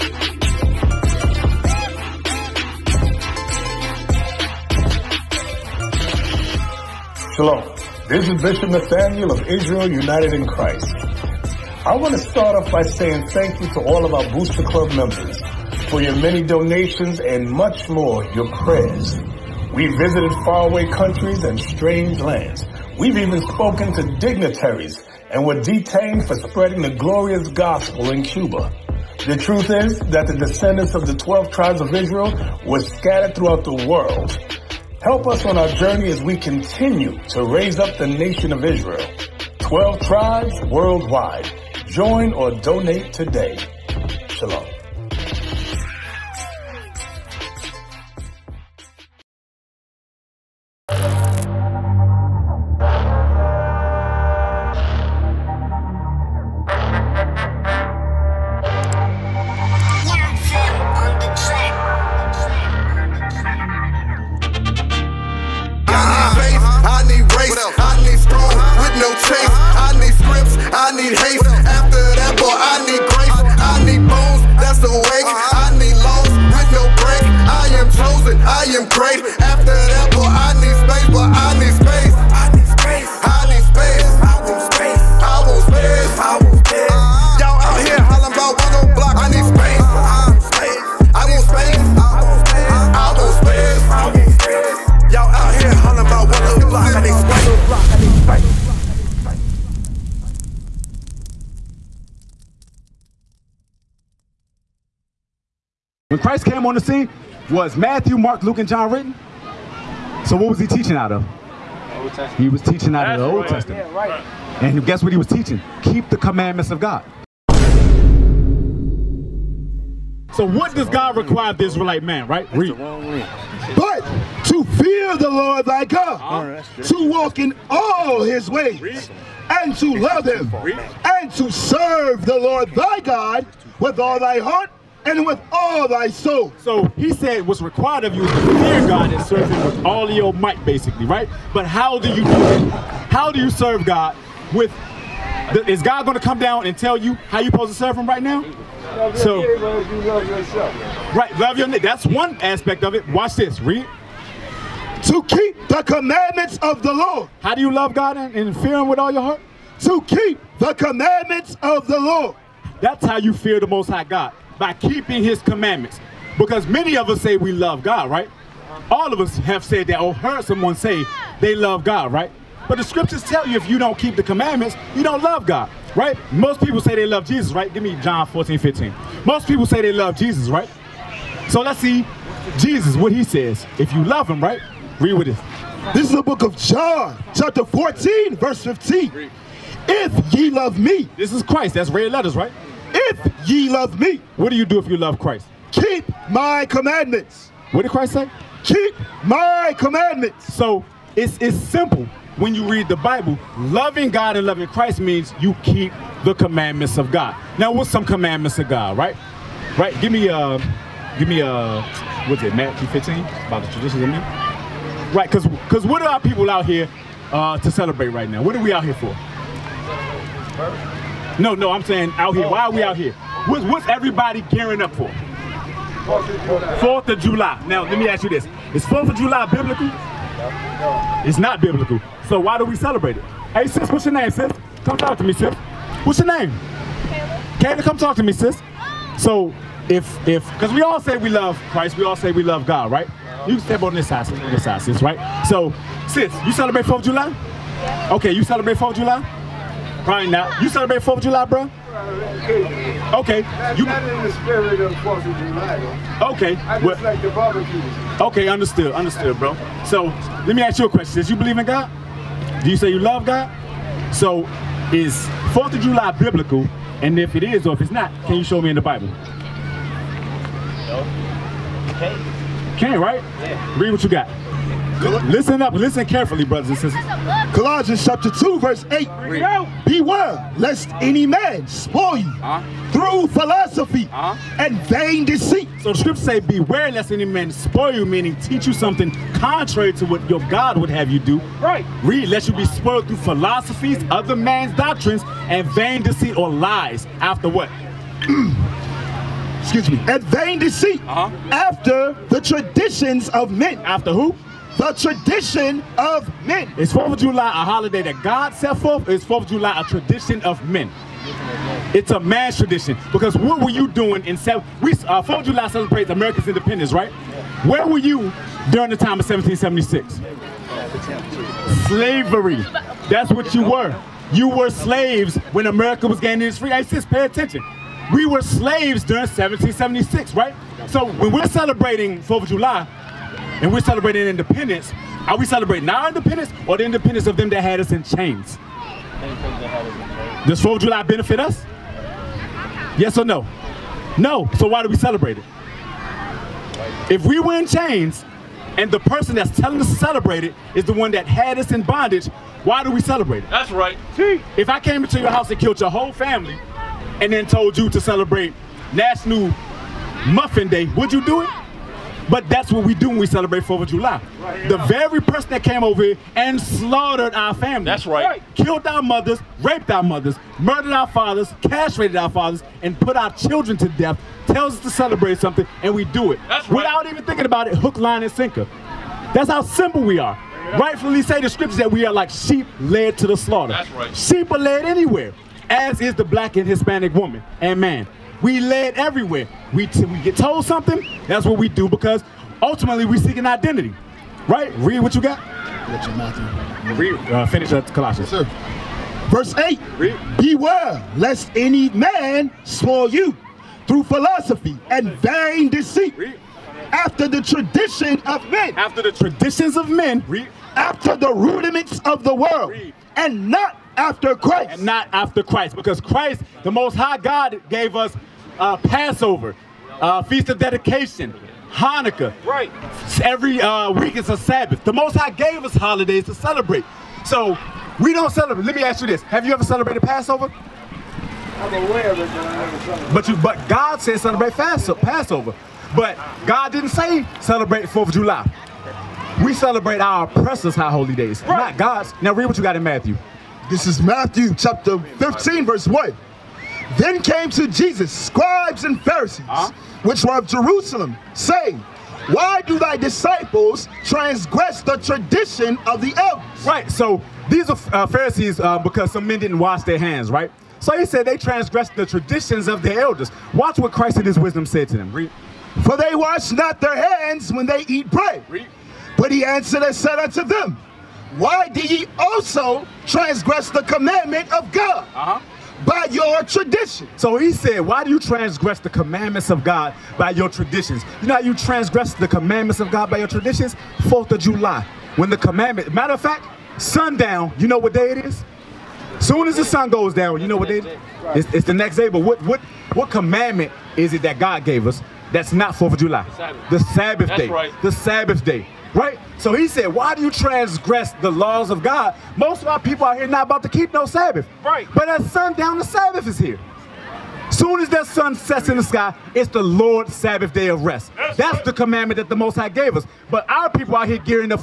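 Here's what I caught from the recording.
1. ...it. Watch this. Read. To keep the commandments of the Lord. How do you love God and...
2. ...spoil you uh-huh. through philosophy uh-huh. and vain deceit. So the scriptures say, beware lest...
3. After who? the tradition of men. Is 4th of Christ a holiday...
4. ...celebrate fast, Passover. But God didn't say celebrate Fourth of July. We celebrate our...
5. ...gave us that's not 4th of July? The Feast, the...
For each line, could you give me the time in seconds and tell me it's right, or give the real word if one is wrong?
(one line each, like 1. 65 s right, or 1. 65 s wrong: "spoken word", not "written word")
1. 152 s right
2. 281 s right
3. 303 s wrong: "July", not "Christ"
4. 434 s right
5. 494 s wrong: "Sabbath", not "Feast".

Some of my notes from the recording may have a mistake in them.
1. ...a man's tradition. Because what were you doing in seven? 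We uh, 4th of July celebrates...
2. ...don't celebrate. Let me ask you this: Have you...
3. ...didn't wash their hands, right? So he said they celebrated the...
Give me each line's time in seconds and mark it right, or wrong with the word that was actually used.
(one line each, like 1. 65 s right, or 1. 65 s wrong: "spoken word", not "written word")
1. 312 s right
2. 428 s right
3. 459 s wrong: "transgressed", not "celebrated".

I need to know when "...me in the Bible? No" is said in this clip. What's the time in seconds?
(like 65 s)
268 s.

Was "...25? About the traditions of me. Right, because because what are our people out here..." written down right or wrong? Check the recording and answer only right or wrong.
wrong.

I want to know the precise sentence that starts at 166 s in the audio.
Because many of us say we love God, right?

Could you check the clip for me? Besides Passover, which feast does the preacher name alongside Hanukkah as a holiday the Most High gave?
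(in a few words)
Feast of Dedication.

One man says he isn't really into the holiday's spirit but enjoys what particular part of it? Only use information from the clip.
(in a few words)
the barbecue.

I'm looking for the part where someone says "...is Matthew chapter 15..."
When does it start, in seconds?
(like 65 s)
443 s.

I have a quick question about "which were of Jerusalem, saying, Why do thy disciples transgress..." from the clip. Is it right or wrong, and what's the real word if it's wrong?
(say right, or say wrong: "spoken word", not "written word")
right.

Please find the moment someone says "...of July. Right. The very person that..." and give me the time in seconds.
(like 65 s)
363 s.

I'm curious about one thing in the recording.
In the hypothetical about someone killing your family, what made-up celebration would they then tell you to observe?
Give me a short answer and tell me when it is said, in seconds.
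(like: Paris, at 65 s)
National Muffin Day, at 358 s.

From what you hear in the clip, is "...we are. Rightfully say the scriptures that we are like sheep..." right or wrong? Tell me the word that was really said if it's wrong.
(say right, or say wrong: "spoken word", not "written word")
right.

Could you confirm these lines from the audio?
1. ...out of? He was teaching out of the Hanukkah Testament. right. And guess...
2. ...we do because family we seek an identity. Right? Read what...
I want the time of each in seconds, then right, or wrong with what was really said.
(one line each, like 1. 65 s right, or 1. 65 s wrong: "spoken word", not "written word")
1. 110 s wrong: "Old", not "Hanukkah"
2. 391 s wrong: "ultimately", not "family".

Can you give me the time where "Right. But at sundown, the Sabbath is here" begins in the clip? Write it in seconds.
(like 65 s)
504 s.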